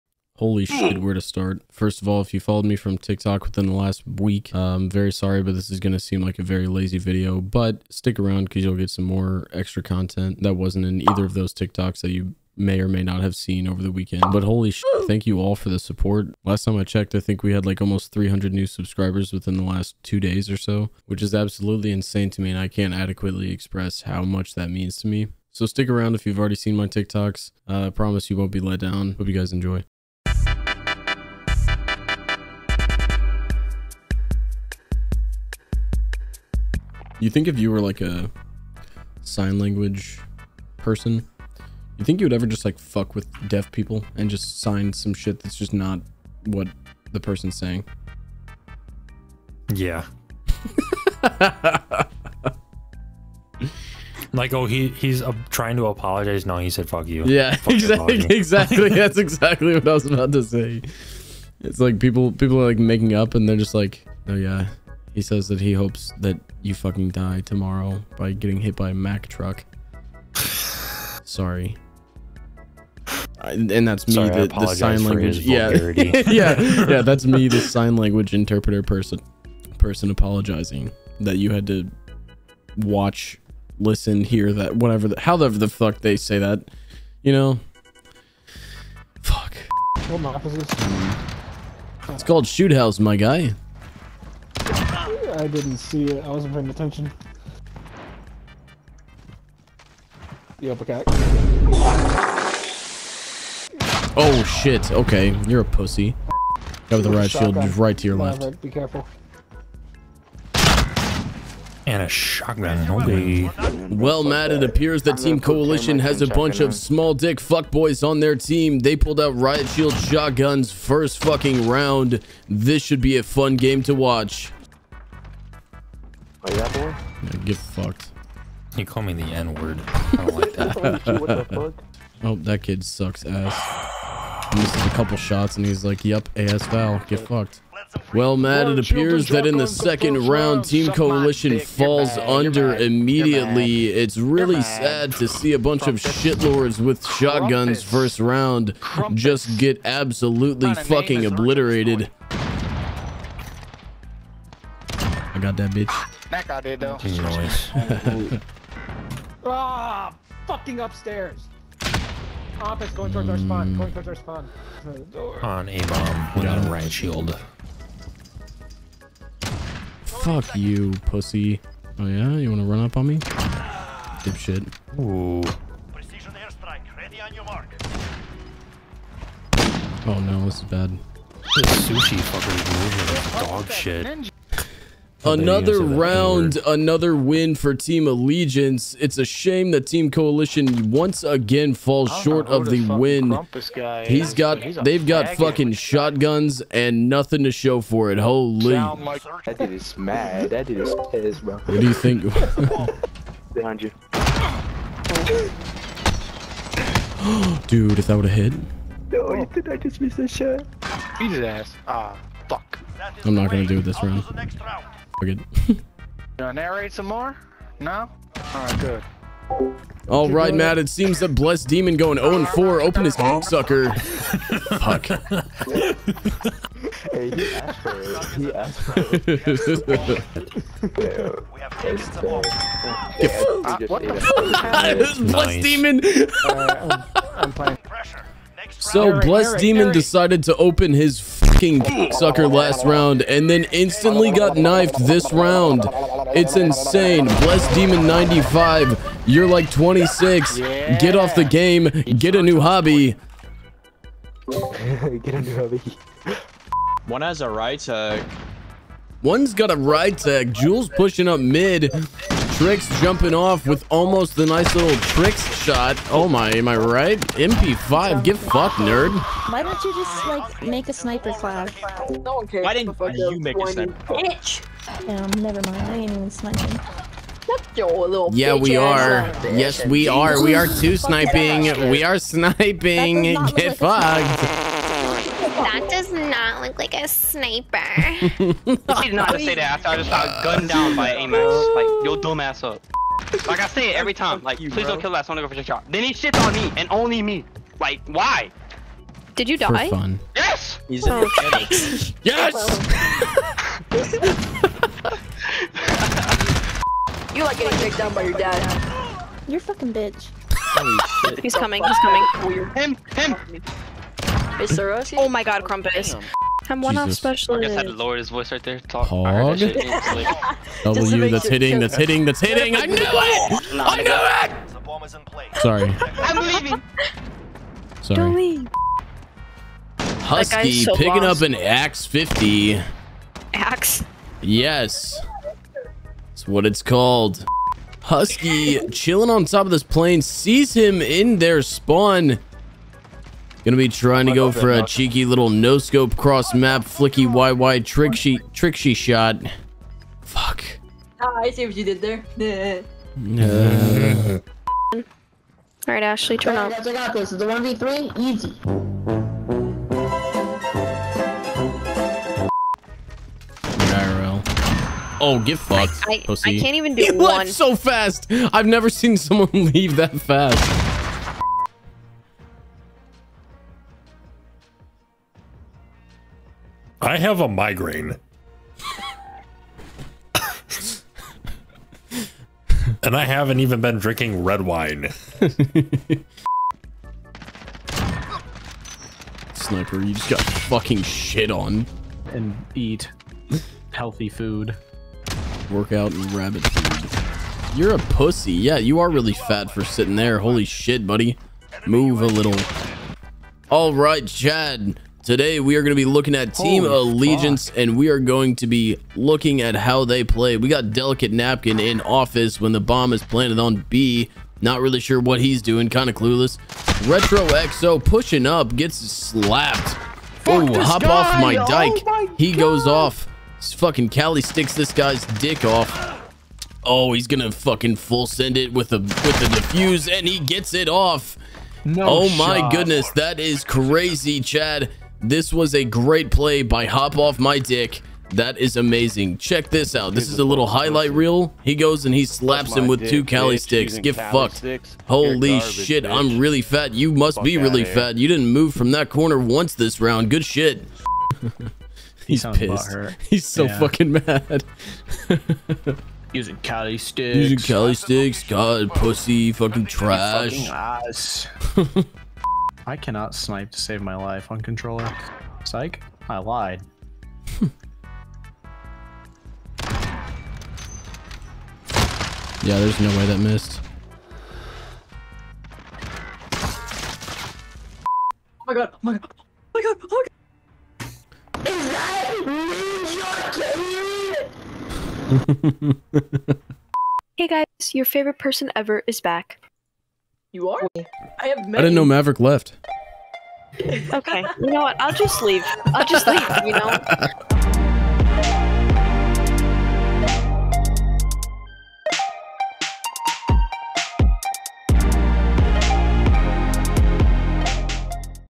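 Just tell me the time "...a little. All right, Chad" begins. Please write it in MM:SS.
06:42.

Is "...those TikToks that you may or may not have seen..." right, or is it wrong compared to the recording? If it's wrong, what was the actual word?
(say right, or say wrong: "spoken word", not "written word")
right.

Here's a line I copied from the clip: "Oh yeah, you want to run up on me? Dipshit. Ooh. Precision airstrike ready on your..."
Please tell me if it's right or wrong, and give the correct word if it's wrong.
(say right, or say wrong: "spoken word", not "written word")
right.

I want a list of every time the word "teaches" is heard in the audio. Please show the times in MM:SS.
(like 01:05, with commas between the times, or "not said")
not said.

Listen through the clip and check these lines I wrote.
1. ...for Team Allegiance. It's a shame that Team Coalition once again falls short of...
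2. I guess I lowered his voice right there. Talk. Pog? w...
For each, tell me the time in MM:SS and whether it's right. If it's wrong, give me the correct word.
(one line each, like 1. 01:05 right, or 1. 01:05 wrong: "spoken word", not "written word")
1. 03:07 right
2. 05:17 right.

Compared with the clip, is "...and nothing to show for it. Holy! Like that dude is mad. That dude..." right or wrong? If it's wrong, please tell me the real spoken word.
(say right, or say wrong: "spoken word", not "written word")
right.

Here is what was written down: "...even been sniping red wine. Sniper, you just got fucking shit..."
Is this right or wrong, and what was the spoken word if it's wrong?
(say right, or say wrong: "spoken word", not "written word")
wrong: "drinking", not "sniping".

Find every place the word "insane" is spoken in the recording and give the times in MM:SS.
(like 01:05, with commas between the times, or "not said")
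00:21, 04:06.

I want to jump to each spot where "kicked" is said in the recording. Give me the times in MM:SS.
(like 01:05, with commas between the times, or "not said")
05:07.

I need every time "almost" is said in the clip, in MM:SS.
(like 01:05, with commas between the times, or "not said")
00:17, 04:23.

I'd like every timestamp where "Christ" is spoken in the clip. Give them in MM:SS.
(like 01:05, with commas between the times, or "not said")
not said.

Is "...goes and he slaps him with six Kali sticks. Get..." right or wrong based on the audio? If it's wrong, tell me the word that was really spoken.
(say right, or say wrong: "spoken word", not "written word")
wrong: "two", not "six".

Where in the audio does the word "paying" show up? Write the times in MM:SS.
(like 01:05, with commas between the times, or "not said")
01:36.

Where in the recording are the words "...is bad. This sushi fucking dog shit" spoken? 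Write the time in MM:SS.
03:00.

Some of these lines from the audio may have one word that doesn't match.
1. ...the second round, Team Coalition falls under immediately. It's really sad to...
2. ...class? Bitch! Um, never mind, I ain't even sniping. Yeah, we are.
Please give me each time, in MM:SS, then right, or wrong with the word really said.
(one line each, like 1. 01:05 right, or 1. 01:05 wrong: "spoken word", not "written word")
1. 02:19 right
2. 04:34 right.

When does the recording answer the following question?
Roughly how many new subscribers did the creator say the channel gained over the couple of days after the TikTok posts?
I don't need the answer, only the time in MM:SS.
00:18.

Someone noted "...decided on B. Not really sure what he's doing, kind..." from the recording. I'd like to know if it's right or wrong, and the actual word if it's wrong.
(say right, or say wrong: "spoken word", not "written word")
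wrong: "planted", not "decided".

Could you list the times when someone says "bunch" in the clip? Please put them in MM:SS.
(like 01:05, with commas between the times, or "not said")
01:56, 02:25.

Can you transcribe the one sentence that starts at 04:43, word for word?
Get fucked does not look like a sniper.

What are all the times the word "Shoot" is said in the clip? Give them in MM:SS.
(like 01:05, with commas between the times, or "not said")
01:32.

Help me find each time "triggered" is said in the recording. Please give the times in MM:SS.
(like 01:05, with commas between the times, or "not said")
not said.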